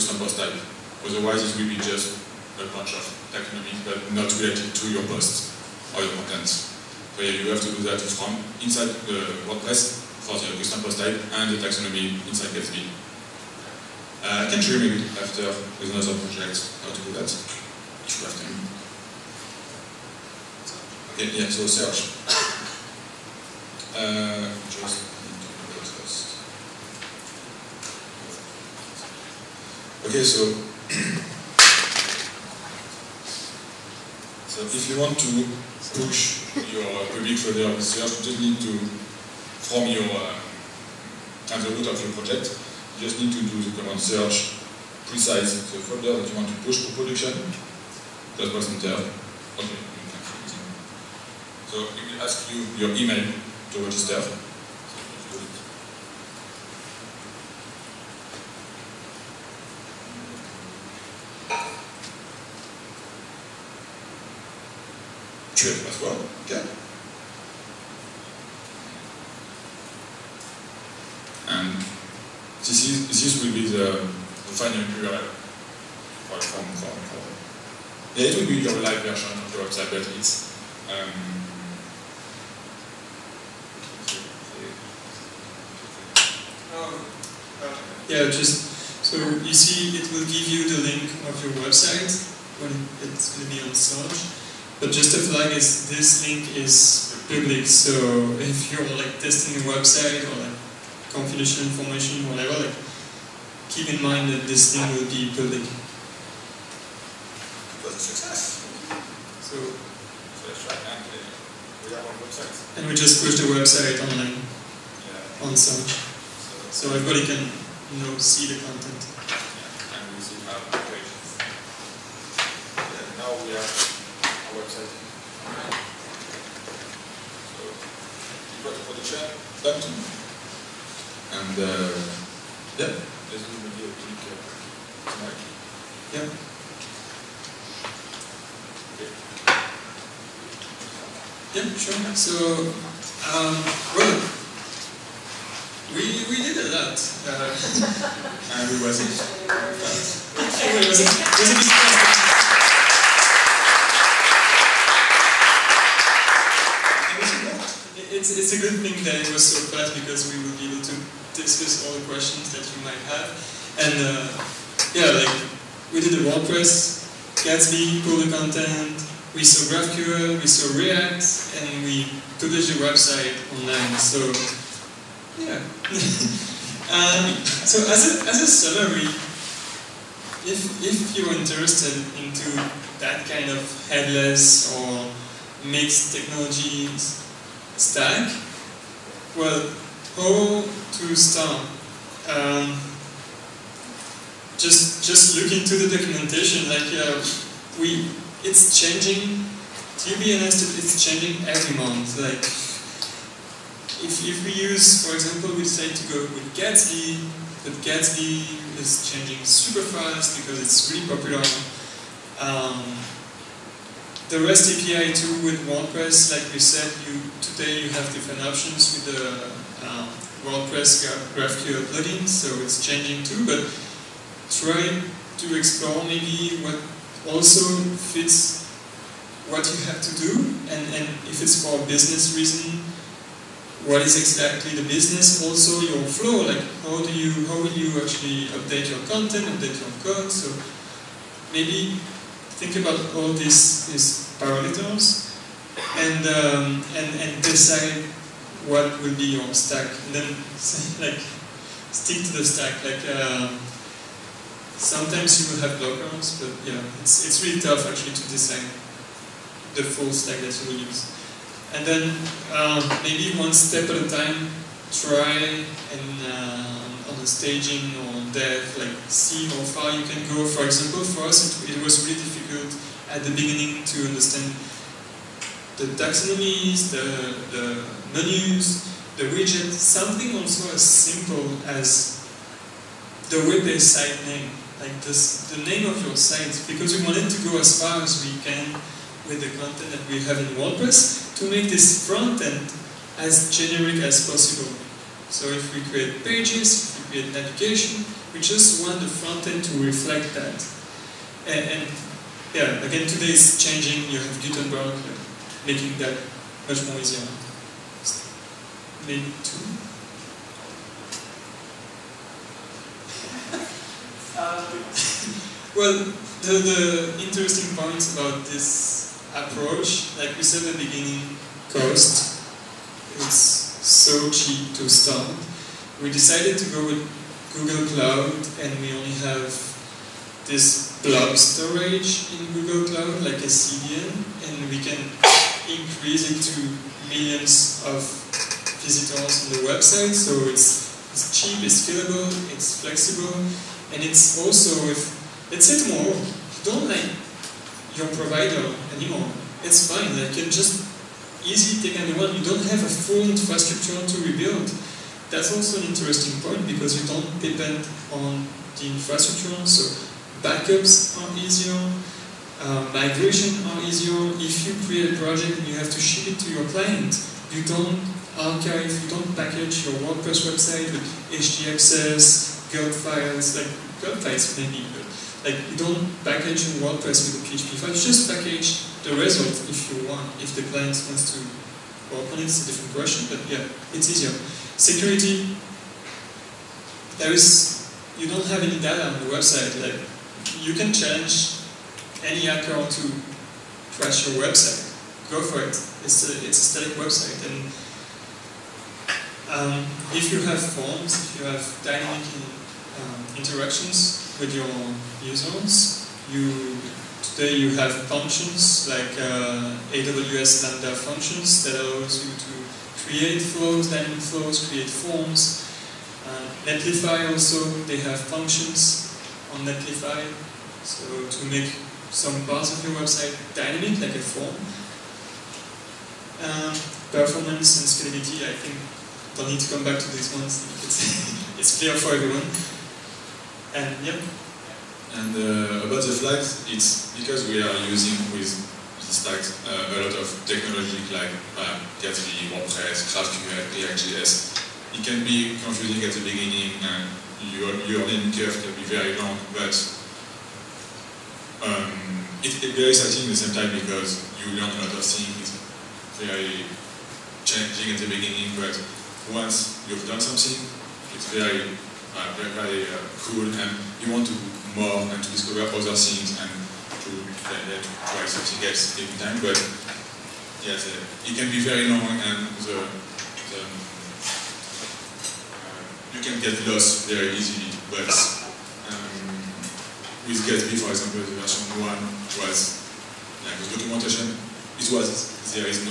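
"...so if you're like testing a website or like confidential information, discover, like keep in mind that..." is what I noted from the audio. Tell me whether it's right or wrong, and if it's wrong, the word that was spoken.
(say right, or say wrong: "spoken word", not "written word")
wrong: "whatever", not "discover".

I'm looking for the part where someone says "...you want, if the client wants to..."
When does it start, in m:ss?
6:19.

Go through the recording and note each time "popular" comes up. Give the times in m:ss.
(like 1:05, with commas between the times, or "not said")
3:31.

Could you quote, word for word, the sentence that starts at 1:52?
And we just push the website online yeah.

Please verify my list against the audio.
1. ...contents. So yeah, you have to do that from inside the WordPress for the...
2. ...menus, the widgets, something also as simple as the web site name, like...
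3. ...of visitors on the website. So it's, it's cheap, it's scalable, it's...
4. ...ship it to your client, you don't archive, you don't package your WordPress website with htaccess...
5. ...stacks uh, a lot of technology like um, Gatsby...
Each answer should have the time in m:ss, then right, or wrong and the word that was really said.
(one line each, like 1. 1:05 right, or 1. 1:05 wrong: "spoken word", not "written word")
1. 0:06 right
2. 4:38 right
3. 5:37 right
4. 6:05 right
5. 7:19 right.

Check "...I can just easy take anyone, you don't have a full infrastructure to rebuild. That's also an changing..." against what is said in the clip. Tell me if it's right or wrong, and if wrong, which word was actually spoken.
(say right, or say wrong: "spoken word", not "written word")
wrong: "interesting", not "changing".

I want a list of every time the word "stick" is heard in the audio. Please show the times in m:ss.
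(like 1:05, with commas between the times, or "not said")
4:11.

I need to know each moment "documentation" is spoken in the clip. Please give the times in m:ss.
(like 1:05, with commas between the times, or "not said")
3:15, 8:03.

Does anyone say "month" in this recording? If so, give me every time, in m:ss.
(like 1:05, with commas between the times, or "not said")
3:21.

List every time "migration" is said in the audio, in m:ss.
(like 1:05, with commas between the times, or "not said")
6:02.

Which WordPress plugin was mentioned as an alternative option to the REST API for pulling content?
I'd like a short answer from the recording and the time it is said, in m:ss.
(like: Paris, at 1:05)
WordPress GraphQL plugin, at 3:40.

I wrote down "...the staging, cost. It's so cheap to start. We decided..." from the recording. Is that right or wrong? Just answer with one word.
wrong.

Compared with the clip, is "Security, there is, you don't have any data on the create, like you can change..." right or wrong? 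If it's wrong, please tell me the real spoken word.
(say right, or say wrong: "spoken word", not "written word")
wrong: "website", not "create".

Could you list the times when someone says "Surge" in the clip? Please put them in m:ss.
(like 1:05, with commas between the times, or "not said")
0:21, 0:43, 1:33.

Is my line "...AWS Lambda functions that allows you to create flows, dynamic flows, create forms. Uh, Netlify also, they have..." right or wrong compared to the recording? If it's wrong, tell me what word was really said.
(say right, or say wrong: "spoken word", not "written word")
right.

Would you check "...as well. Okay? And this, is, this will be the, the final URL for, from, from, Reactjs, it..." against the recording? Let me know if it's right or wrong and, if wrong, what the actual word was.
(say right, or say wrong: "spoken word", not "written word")
wrong: "Yeah", not "Reactjs".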